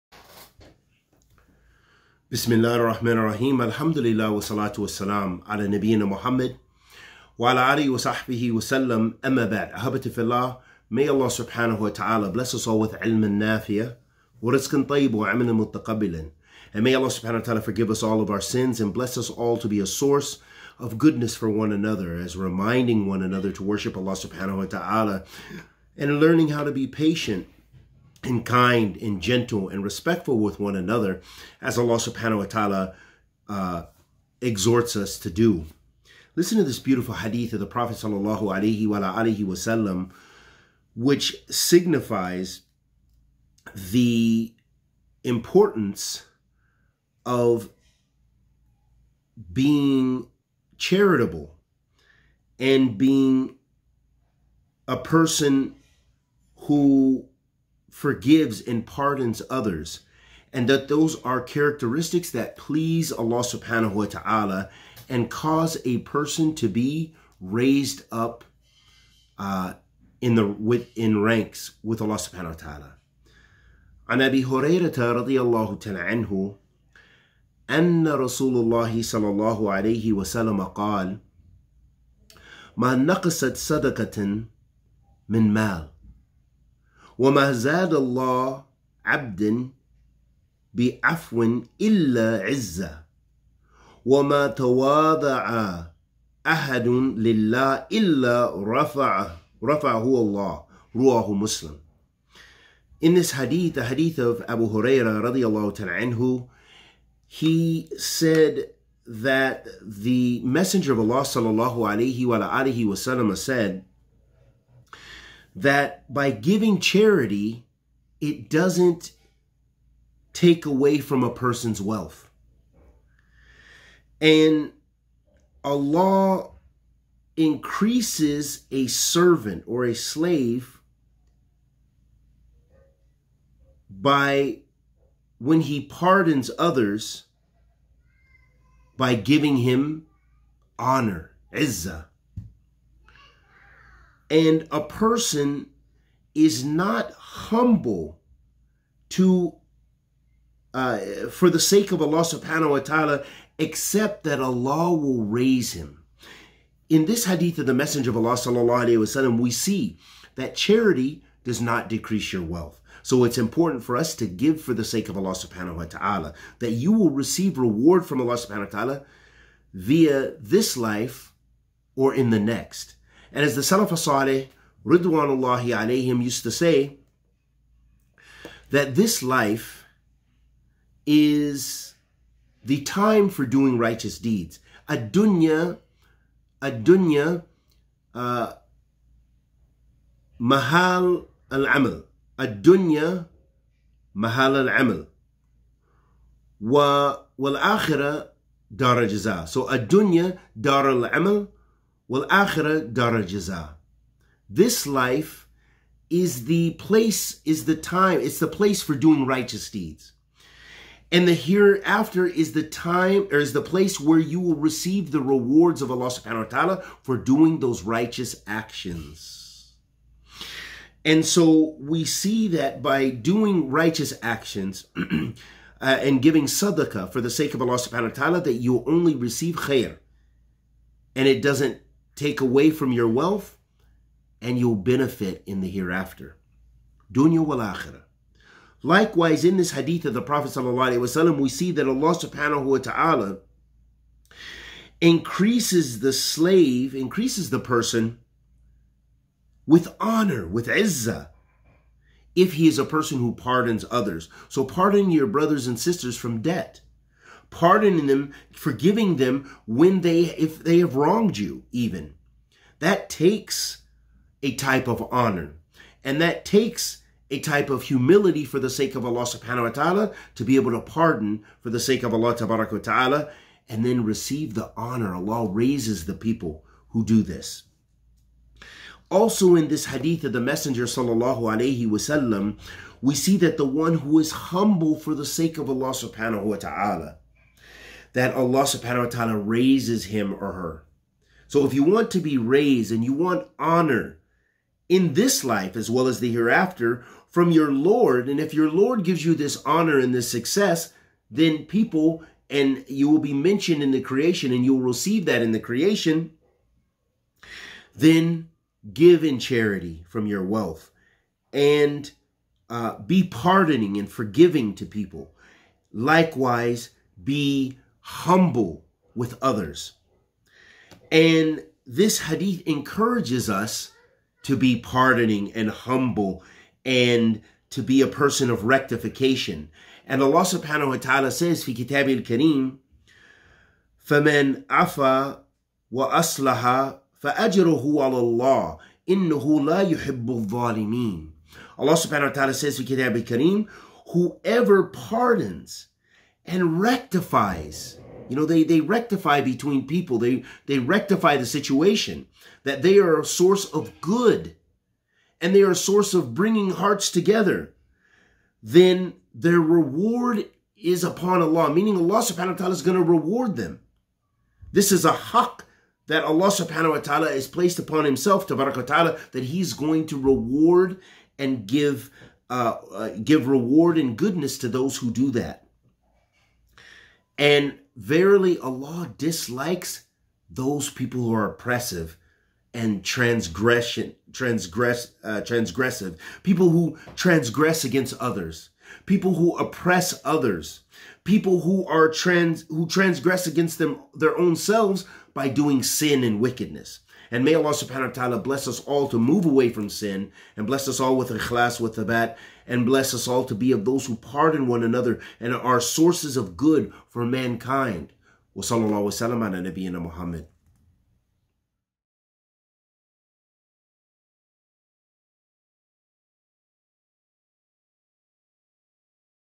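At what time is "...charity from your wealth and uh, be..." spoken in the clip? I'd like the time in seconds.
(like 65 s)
309 s.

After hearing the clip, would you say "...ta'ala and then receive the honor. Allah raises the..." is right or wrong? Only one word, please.
right.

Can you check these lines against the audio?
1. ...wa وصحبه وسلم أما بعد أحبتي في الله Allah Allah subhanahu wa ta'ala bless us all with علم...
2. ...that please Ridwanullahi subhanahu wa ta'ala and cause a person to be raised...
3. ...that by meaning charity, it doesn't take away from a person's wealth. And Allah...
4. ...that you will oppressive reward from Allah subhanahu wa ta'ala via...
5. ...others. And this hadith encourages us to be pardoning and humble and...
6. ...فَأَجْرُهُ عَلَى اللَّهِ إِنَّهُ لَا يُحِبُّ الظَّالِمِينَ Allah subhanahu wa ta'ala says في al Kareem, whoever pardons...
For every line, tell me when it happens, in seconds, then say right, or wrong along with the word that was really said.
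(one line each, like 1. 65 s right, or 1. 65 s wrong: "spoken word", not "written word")
1. 7 s wrong: "May", not "Allah"
2. 62 s wrong: "Allah", not "Ridwanullahi"
3. 115 s wrong: "giving", not "meaning"
4. 166 s wrong: "receive", not "oppressive"
5. 319 s right
6. 337 s right.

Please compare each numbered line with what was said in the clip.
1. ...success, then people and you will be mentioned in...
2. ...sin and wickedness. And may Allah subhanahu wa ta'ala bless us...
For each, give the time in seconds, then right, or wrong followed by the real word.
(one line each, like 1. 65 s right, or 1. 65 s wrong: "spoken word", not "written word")
1. 300 s right
2. 395 s right.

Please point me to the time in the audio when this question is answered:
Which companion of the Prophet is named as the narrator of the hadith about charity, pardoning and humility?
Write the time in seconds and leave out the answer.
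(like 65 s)
104 s.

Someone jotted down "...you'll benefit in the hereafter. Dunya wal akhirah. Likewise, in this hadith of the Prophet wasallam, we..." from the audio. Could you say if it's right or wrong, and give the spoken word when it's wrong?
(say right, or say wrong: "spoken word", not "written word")
right.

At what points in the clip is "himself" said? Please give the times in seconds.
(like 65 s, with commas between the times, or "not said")
368 s.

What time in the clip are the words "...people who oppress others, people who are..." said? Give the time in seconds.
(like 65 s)
389 s.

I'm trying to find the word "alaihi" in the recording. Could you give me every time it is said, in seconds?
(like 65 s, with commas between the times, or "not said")
38 s, 281 s.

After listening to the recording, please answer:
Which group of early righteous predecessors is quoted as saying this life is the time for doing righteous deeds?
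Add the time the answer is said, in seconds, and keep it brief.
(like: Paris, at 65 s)
Salaf Saleh, at 173 s.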